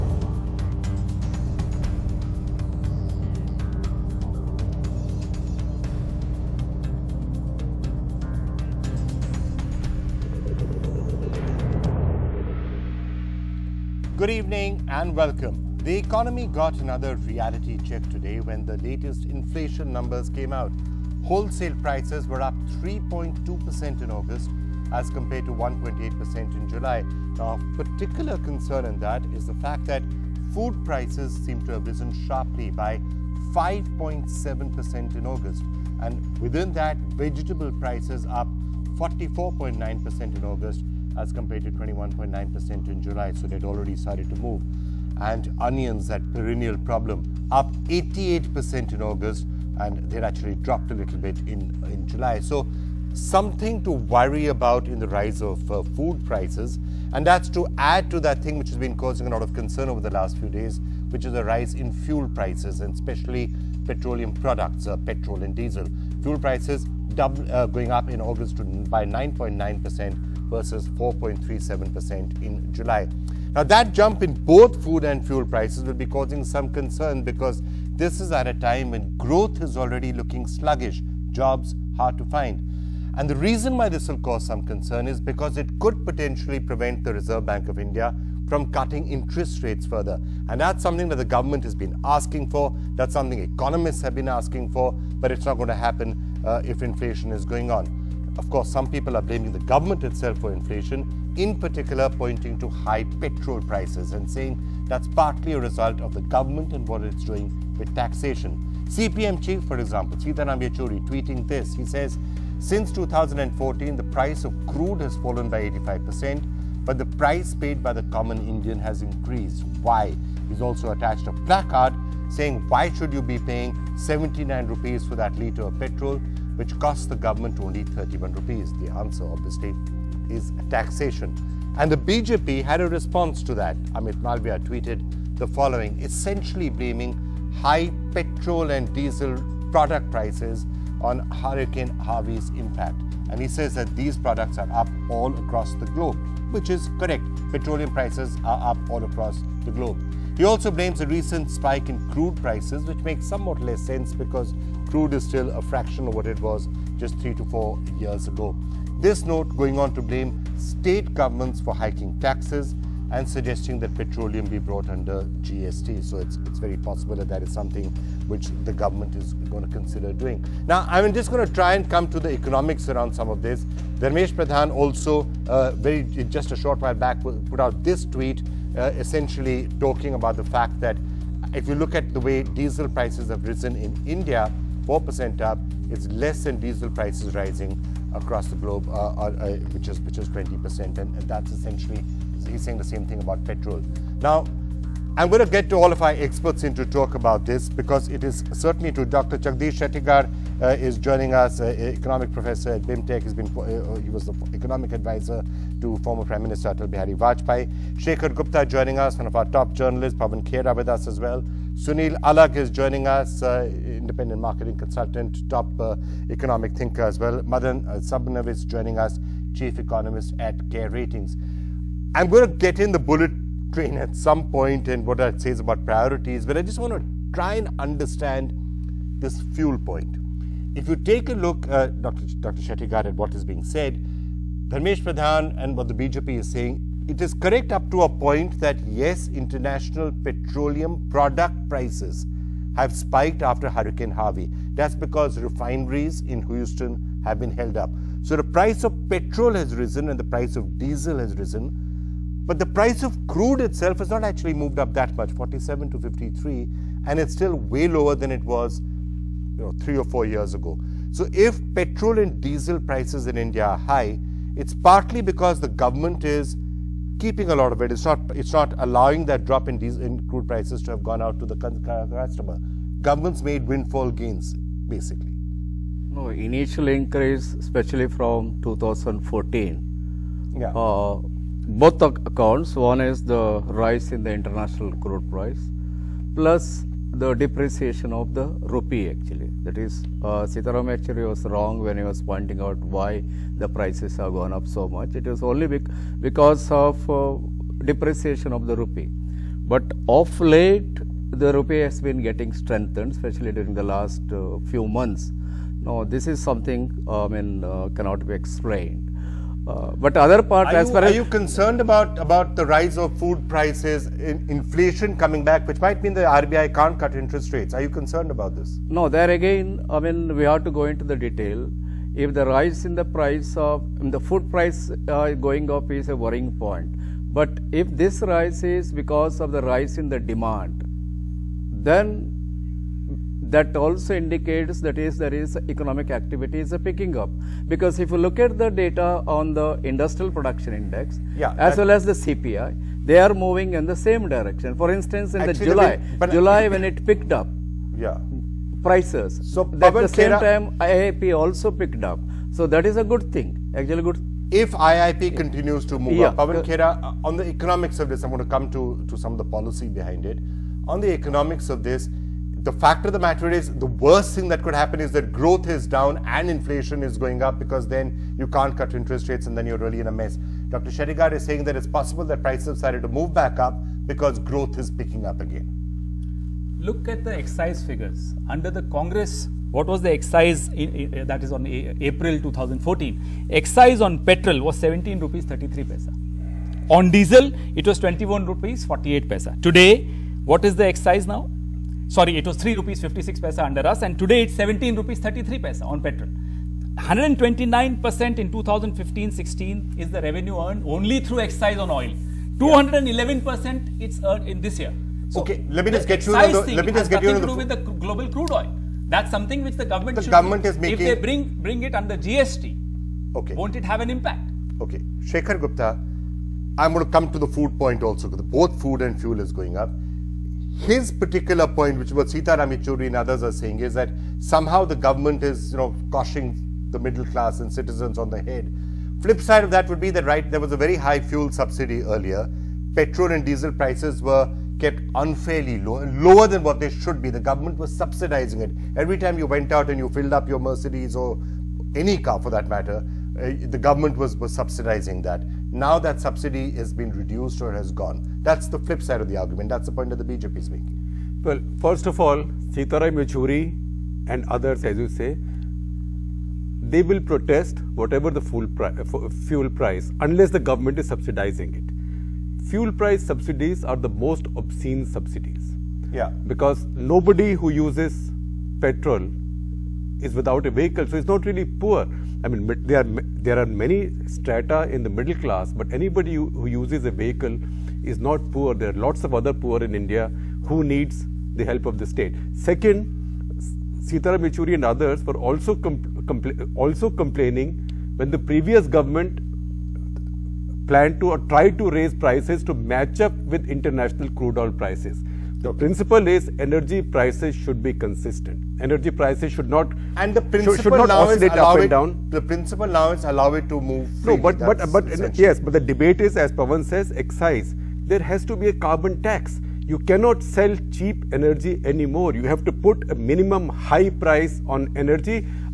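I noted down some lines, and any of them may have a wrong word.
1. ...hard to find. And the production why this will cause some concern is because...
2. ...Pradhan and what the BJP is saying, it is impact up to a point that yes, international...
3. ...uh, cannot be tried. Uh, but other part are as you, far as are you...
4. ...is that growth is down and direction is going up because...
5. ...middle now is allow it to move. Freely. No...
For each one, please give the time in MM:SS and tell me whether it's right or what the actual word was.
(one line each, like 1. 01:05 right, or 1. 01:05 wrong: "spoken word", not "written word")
1. 01:21 wrong: "reason", not "production"
2. 03:55 wrong: "correct", not "impact"
3. 05:07 wrong: "explained", not "tried"
4. 06:04 wrong: "inflation", not "direction"
5. 08:22 wrong: "principle", not "middle".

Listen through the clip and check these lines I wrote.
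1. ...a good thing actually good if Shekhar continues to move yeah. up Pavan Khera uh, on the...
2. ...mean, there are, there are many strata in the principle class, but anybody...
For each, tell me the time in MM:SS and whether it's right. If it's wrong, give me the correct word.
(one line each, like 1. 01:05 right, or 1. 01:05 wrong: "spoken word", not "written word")
1. 05:52 wrong: "IIP", not "Shekhar"
2. 07:52 wrong: "middle", not "principle".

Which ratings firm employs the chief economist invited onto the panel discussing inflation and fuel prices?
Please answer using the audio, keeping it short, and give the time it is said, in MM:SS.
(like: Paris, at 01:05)
Care Ratings, at 03:40.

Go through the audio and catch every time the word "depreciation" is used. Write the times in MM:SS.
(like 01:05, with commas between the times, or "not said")
04:47, 04:57.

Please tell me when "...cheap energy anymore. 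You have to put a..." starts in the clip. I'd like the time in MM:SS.
08:30.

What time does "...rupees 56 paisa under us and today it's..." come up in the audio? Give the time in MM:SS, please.
06:32.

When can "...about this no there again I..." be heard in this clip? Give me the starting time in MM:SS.
05:18.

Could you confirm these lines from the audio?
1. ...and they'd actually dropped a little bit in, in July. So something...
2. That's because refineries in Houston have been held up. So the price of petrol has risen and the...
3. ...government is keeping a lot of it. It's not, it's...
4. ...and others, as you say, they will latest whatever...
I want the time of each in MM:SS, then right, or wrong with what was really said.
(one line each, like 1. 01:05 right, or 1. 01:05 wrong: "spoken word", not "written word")
1. 00:49 right
2. 04:04 right
3. 04:25 right
4. 07:34 wrong: "protest", not "latest".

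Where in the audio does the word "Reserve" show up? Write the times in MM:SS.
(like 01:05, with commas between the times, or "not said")
01:27.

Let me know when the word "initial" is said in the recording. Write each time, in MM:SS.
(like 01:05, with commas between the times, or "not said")
04:36.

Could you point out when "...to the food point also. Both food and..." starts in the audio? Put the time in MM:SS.
06:57.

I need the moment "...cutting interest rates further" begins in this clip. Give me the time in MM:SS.
01:28.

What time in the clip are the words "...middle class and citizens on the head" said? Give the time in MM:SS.
07:06.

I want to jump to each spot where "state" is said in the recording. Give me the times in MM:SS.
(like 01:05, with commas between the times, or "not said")
02:40, 08:02.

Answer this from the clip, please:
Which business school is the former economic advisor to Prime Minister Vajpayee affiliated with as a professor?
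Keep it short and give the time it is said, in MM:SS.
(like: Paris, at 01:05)
BIMTech, at 03:22.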